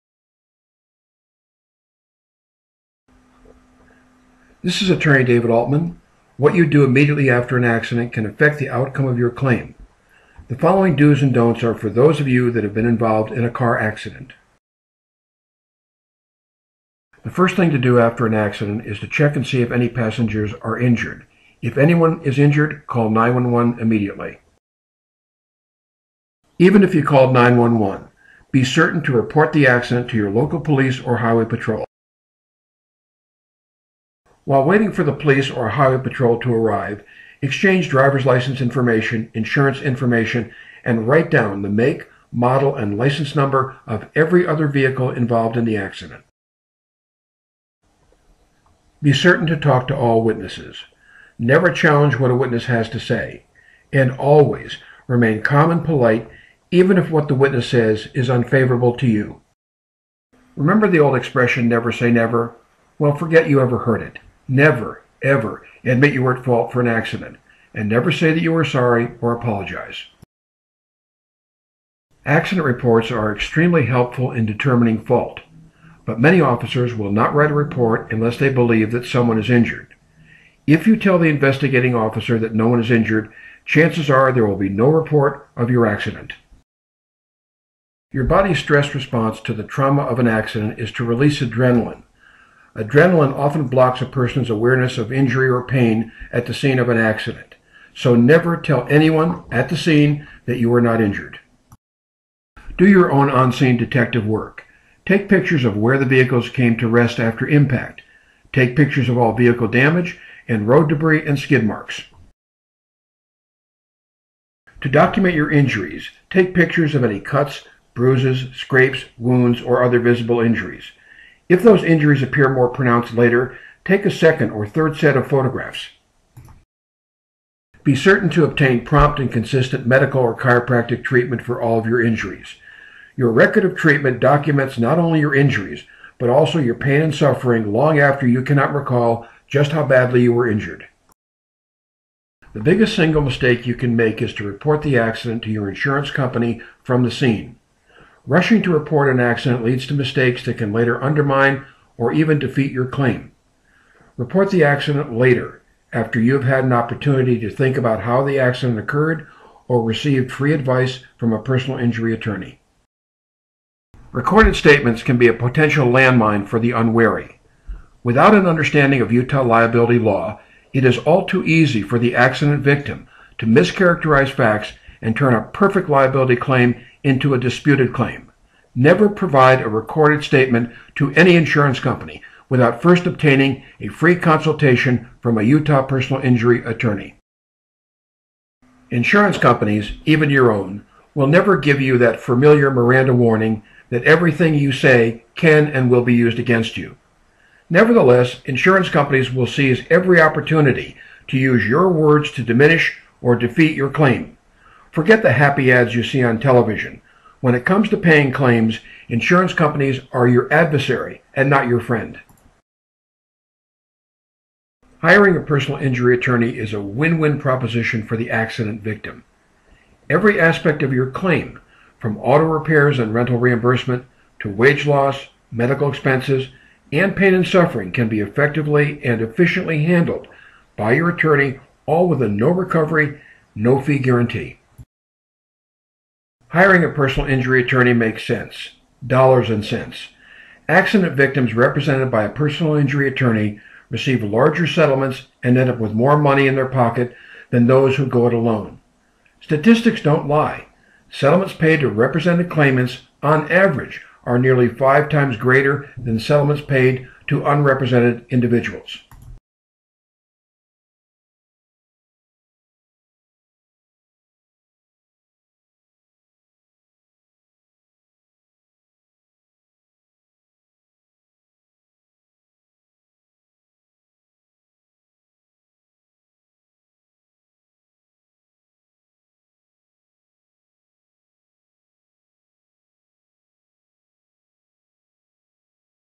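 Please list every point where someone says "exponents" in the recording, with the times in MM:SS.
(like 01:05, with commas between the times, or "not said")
not said.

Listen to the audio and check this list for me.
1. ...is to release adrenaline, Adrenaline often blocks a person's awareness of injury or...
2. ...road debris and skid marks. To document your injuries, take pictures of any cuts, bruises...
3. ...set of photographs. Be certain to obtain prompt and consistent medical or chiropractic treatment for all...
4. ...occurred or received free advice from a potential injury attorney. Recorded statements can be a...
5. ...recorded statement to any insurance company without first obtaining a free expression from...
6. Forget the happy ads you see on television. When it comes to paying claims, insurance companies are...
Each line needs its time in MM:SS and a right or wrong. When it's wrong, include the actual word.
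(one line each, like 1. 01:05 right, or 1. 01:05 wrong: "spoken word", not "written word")
1. 01:30 right
2. 01:50 right
3. 02:04 right
4. 02:38 wrong: "personal", not "potential"
5. 02:59 wrong: "consultation", not "expression"
6. 03:24 right.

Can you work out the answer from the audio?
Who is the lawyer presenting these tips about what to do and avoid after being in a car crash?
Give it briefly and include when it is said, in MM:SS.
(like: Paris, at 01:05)
David Altman, at 00:05.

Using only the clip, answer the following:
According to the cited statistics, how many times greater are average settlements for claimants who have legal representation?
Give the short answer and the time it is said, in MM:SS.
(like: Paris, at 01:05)
nearly 5 times, at 04:14.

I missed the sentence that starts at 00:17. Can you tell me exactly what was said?
The first thing to do after an accident is to check and see if any passengers are injured.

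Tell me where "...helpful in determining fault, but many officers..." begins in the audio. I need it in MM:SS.
01:13.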